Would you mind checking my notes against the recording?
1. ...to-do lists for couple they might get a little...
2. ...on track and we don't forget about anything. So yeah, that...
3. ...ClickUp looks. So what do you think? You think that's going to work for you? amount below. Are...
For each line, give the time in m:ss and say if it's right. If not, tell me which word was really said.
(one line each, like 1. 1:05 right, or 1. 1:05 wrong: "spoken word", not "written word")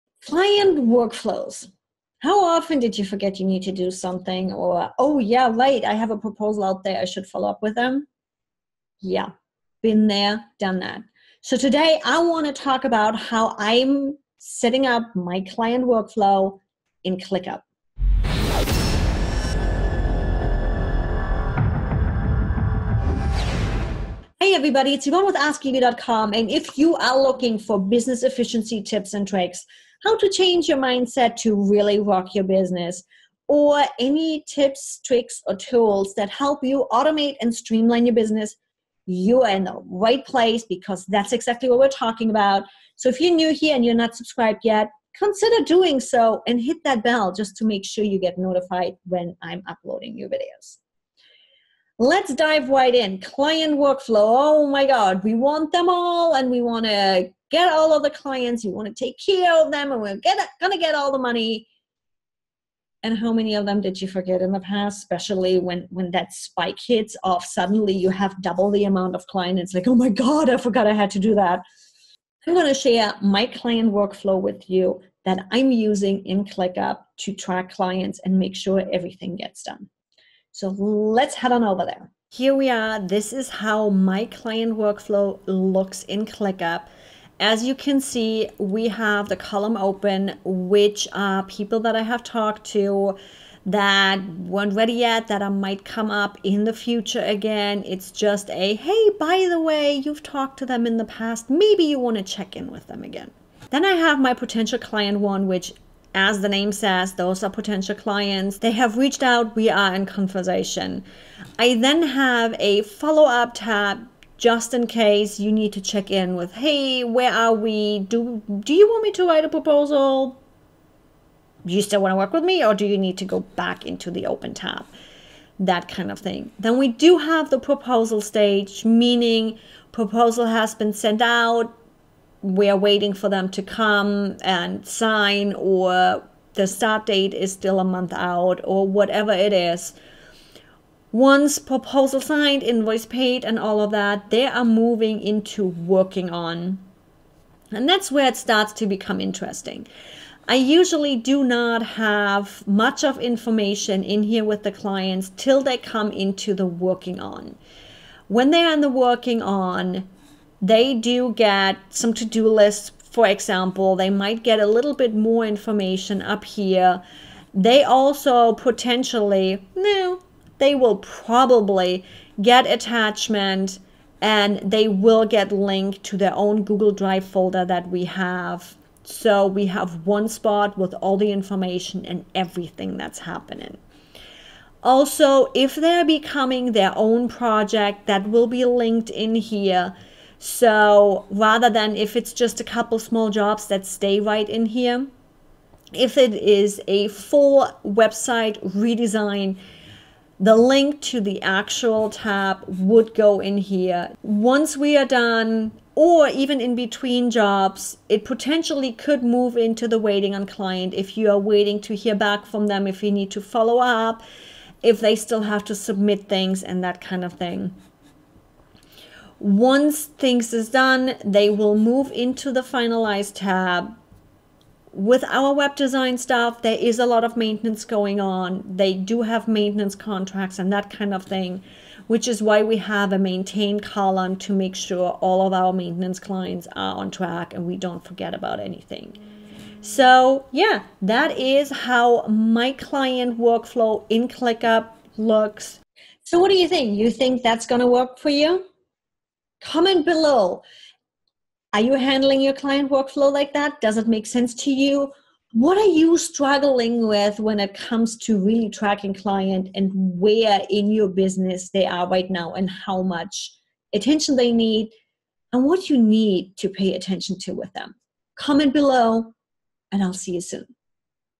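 1. 2:42 wrong: "example", not "couple"
2. 3:56 right
3. 4:04 wrong: "comment", not "amount".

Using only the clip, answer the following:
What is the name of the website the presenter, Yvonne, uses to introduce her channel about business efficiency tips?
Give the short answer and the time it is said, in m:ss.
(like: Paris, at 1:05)
AskYvi.com, at 0:25.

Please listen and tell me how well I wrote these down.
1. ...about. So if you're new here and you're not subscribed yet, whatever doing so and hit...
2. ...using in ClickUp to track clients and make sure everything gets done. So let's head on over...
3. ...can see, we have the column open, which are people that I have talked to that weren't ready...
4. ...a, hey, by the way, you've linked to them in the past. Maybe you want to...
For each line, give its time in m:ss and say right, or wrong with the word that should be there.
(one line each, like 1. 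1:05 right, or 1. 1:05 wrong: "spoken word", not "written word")
1. 0:42 wrong: "consider", not "whatever"
2. 1:15 right
3. 1:27 right
4. 1:38 wrong: "talked", not "linked".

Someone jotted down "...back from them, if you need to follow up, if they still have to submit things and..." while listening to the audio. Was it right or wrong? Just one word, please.
right.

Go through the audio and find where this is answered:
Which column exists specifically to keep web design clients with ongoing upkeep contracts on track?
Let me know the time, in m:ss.
3:53.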